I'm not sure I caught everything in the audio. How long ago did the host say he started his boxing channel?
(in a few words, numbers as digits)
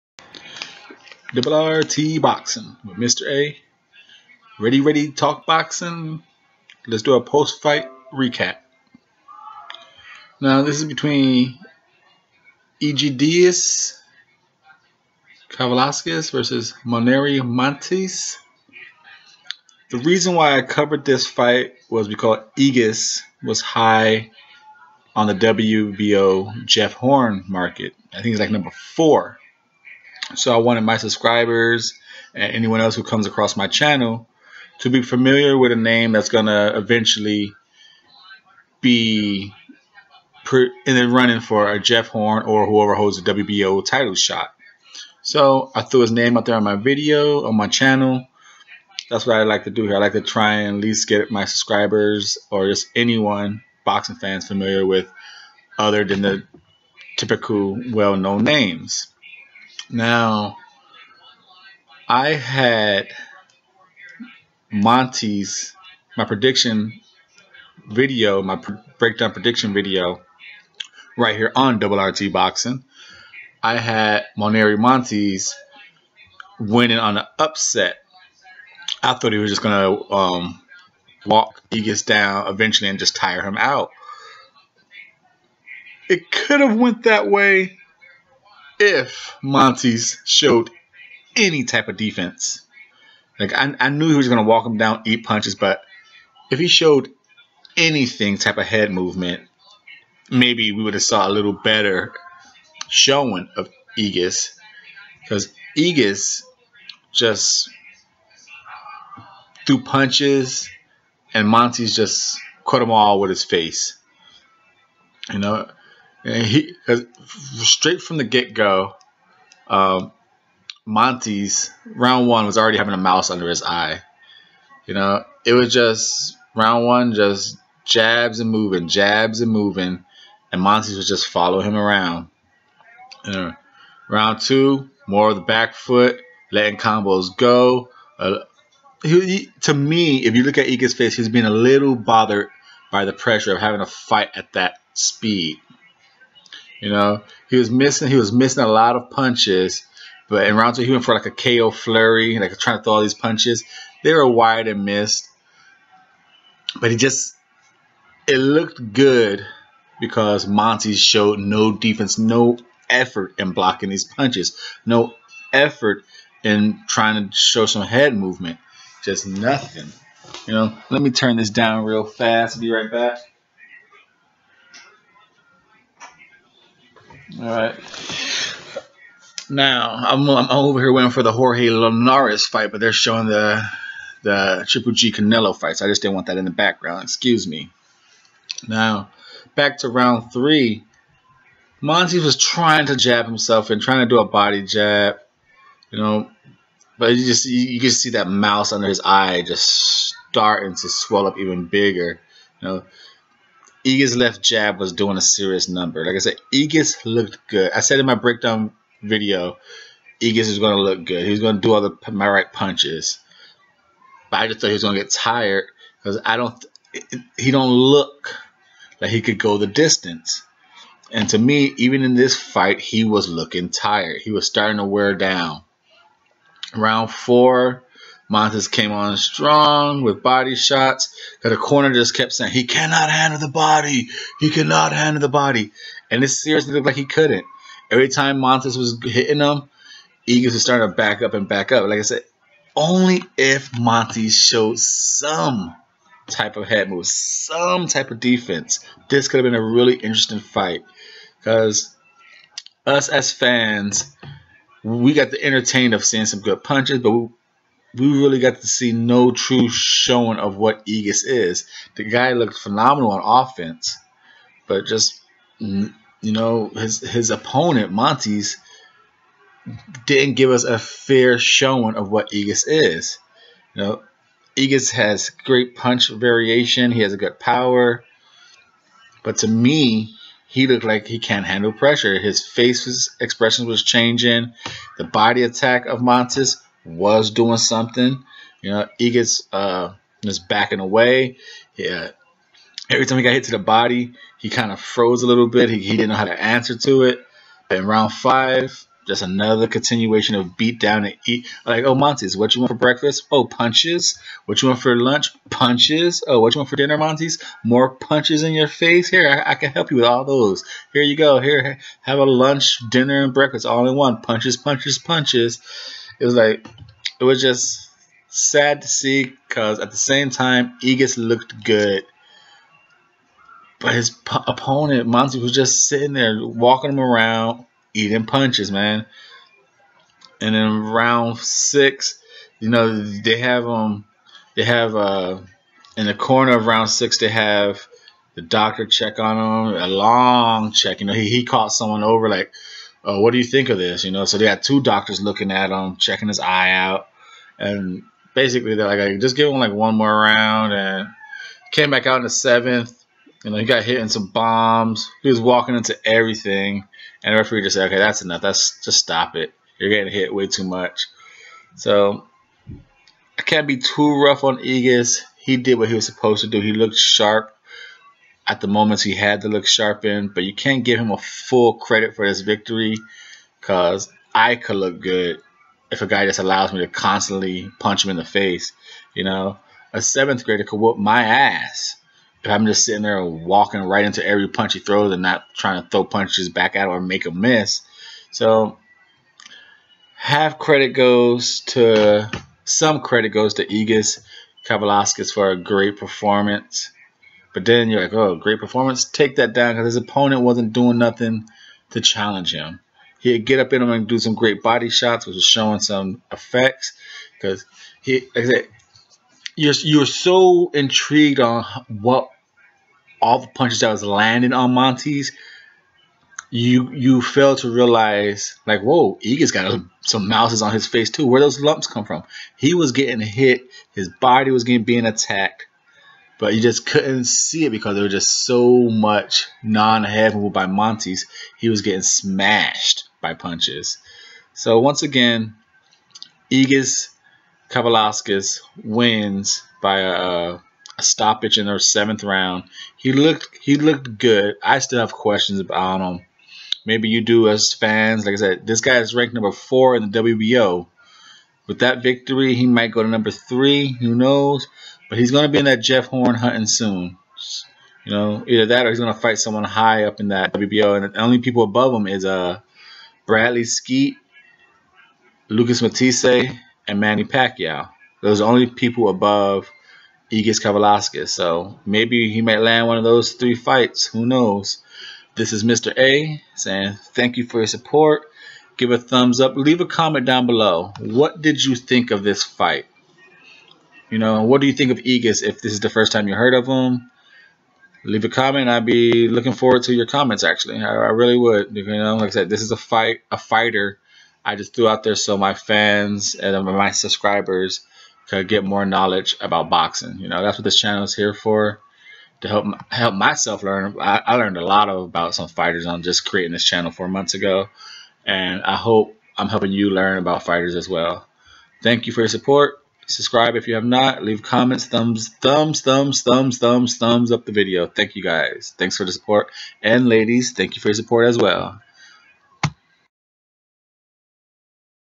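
4 months.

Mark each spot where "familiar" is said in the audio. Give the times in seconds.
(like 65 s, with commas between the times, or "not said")
35 s, 54 s.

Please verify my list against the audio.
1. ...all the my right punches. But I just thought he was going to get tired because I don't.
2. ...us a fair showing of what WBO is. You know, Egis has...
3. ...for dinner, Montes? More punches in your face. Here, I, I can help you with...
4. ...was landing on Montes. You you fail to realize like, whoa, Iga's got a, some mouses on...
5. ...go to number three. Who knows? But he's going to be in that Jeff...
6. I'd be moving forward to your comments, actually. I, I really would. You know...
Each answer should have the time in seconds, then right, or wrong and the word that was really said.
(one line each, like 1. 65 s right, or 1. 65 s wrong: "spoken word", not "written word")
1. 211 s right
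2. 270 s wrong: "Egis", not "WBO"
3. 306 s right
4. 413 s right
5. 452 s right
6. 488 s wrong: "looking", not "moving".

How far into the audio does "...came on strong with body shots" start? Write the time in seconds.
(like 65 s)
228 s.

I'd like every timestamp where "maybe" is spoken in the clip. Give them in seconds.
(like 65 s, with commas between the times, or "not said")
100 s, 446 s, 471 s.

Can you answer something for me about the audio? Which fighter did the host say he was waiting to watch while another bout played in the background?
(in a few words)
Jorge Linares.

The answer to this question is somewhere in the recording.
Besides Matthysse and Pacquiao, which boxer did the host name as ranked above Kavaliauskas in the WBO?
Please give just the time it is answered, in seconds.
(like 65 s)
463 s.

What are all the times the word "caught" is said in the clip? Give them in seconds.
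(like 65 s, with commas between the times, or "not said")
341 s.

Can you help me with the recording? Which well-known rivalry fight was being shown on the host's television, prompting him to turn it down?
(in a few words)
Triple G Canelo.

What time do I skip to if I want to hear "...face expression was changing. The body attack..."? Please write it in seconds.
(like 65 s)
282 s.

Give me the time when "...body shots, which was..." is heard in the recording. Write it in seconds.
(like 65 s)
404 s.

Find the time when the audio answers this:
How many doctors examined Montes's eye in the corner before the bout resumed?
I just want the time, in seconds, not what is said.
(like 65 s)
344 s.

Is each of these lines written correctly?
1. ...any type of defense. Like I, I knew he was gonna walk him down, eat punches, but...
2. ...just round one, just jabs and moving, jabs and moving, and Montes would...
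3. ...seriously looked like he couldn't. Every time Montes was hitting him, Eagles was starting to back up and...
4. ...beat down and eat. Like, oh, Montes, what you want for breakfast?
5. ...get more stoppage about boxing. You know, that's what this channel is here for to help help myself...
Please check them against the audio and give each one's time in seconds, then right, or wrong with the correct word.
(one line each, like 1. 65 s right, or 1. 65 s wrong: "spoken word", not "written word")
1. 91 s right
2. 125 s right
3. 236 s right
4. 300 s right
5. 498 s wrong: "knowledge", not "stoppage".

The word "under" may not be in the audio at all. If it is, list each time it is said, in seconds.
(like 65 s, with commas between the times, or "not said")
123 s, 198 s.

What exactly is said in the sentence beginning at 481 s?
What did you think of this fight?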